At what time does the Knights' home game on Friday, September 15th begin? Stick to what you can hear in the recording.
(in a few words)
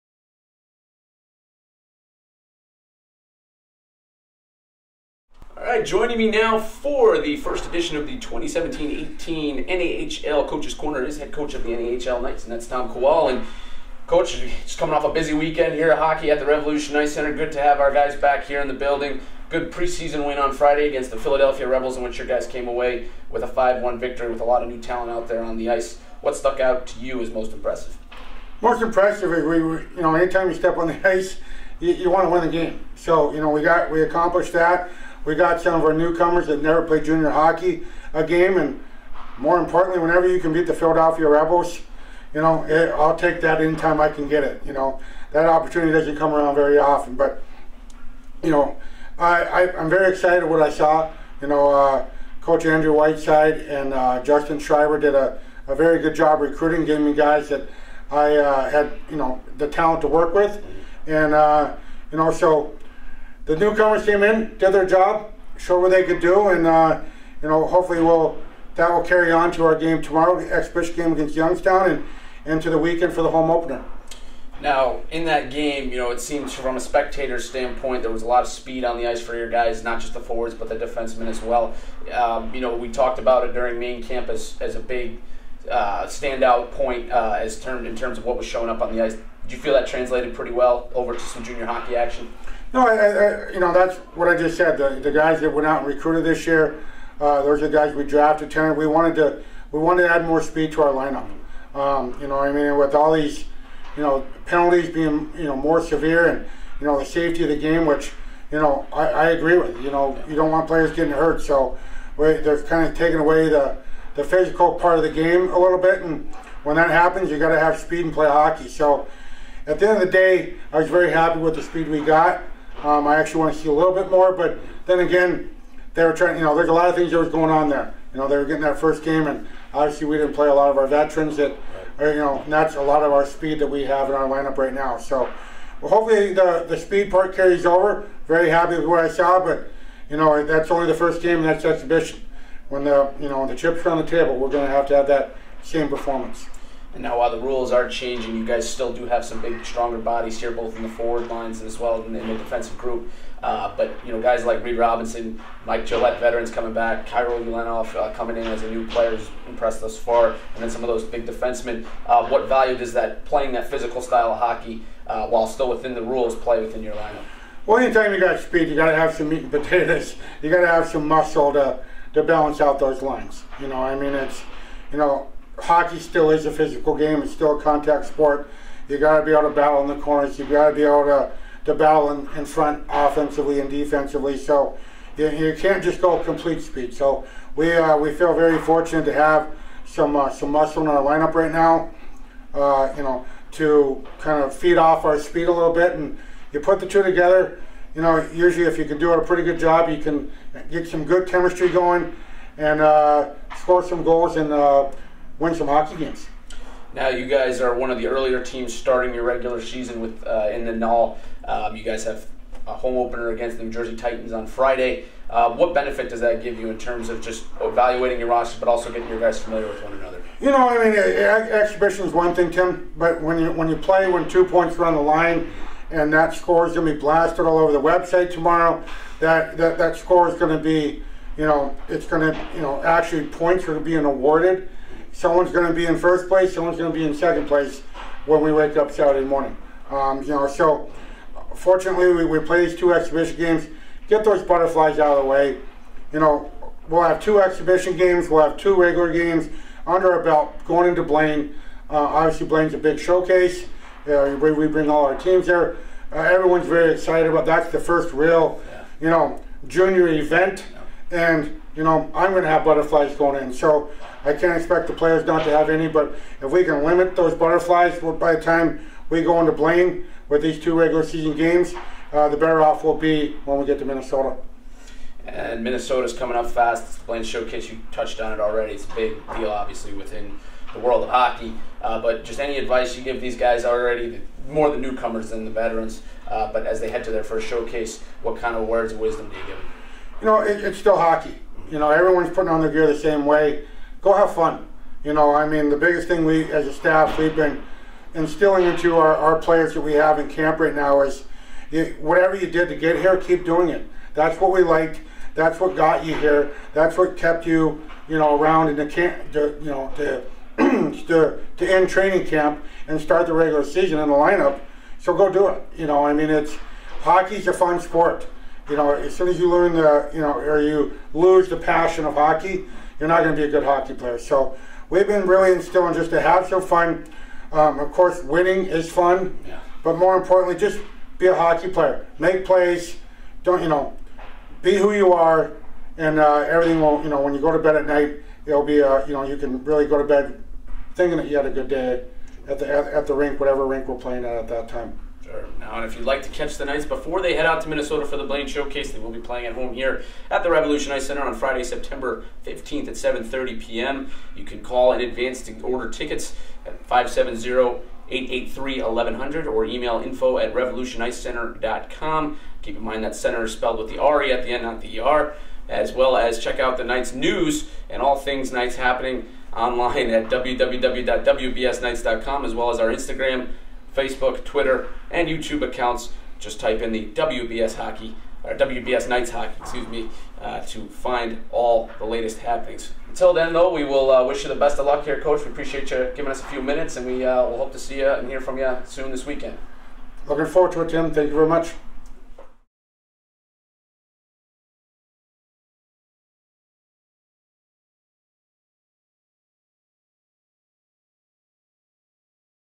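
7:30 p.m.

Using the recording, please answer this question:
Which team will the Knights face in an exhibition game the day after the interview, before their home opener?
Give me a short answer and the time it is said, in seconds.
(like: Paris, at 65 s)
Youngstown, at 71 s.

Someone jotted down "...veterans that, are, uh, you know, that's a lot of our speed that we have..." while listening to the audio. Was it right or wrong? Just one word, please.
right.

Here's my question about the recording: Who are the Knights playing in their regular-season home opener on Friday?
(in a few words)
New Jersey Titans.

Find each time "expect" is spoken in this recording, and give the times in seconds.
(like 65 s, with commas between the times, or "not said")
264 s.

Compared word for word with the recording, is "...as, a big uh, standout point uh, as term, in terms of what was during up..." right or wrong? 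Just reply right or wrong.
wrong.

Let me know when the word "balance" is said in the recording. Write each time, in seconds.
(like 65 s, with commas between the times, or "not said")
172 s.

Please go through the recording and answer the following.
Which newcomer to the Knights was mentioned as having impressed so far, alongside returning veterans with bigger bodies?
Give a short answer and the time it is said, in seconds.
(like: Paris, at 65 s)
Kirill Ulanov, at 157 s.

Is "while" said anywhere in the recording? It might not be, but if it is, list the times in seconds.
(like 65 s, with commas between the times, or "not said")
147 s, 165 s.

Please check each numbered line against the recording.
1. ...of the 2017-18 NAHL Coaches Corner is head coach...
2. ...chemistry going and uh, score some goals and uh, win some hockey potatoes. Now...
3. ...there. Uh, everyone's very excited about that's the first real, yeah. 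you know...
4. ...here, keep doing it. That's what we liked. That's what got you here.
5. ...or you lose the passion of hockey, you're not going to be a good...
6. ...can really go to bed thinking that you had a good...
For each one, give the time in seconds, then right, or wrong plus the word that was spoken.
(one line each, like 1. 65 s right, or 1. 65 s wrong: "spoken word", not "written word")
1. 7 s right
2. 201 s wrong: "games", not "potatoes"
3. 255 s right
4. 302 s right
5. 320 s right
6. 339 s right.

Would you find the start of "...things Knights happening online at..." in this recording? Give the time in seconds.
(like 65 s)
368 s.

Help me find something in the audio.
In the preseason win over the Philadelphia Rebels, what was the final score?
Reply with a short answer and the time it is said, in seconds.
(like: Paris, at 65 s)
5-1, at 23 s.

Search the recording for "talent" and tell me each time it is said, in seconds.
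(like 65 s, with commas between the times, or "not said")
24 s, 59 s.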